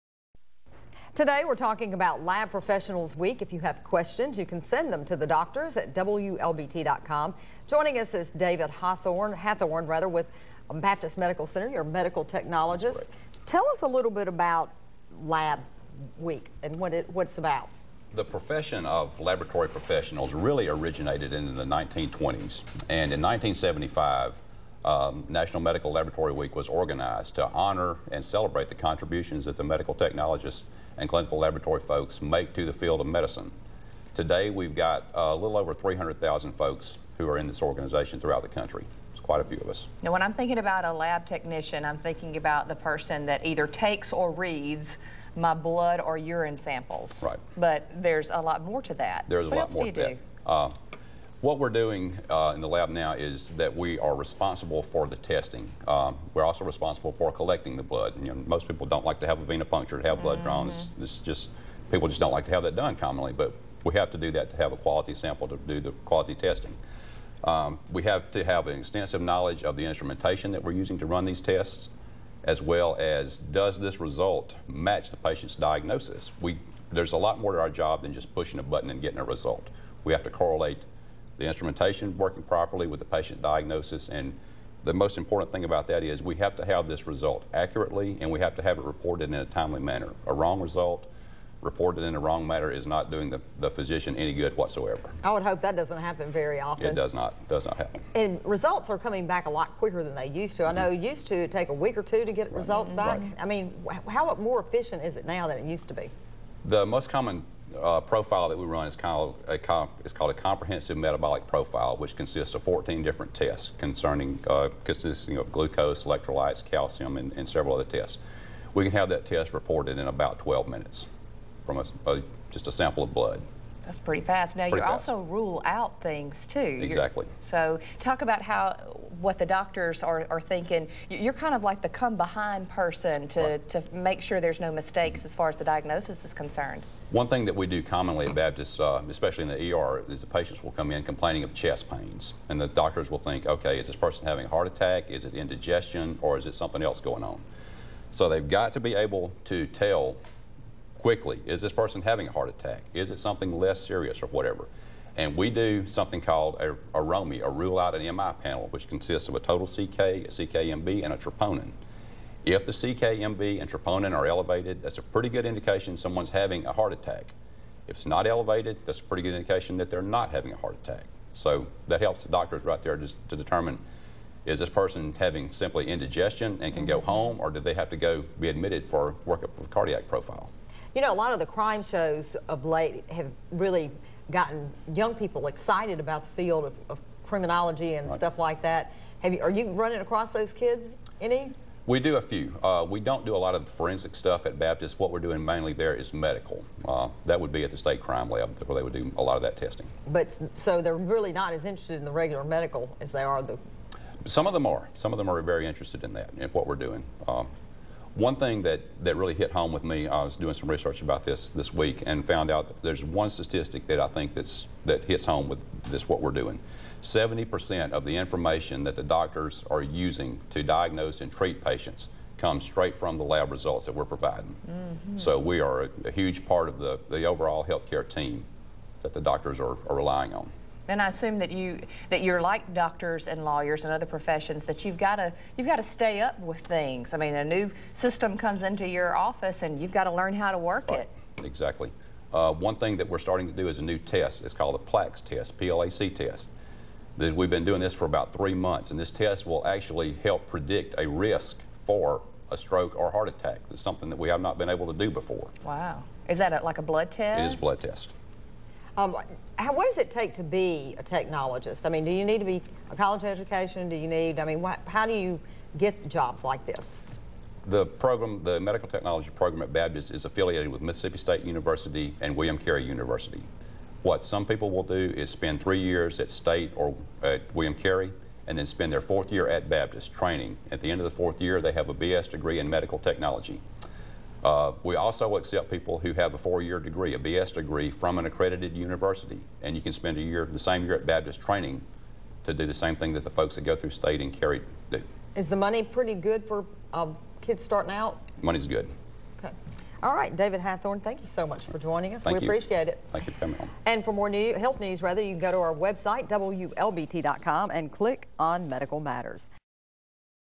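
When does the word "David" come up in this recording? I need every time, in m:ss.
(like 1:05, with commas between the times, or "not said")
0:08, 5:00.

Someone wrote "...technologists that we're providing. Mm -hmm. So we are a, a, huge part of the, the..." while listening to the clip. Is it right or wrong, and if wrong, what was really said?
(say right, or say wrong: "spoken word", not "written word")
wrong: "results", not "technologists".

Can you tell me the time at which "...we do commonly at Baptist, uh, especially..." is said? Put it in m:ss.
2:17.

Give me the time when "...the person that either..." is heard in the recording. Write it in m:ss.
0:42.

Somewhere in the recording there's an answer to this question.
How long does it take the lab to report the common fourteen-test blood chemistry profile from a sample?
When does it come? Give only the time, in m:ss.
2:00.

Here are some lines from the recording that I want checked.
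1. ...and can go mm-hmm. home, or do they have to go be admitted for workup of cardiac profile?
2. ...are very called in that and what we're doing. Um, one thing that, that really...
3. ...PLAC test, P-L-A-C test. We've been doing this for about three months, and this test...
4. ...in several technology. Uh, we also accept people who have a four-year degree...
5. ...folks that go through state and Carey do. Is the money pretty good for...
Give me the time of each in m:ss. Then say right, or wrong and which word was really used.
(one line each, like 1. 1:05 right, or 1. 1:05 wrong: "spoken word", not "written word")
1. 2:56 right
2. 3:25 wrong: "interested", not "called"
3. 4:04 right
4. 4:42 wrong: "medical", not "several"
5. 4:53 right.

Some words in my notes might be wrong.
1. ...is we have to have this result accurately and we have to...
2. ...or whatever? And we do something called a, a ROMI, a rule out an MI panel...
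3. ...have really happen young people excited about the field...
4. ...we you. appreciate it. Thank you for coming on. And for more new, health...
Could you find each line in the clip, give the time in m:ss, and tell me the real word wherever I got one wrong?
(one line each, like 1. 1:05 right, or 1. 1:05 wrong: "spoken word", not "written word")
1. 1:26 right
2. 2:34 right
3. 3:03 wrong: "gotten", not "happen"
4. 5:02 right.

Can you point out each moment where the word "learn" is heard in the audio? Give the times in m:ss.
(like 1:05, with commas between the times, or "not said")
4:00.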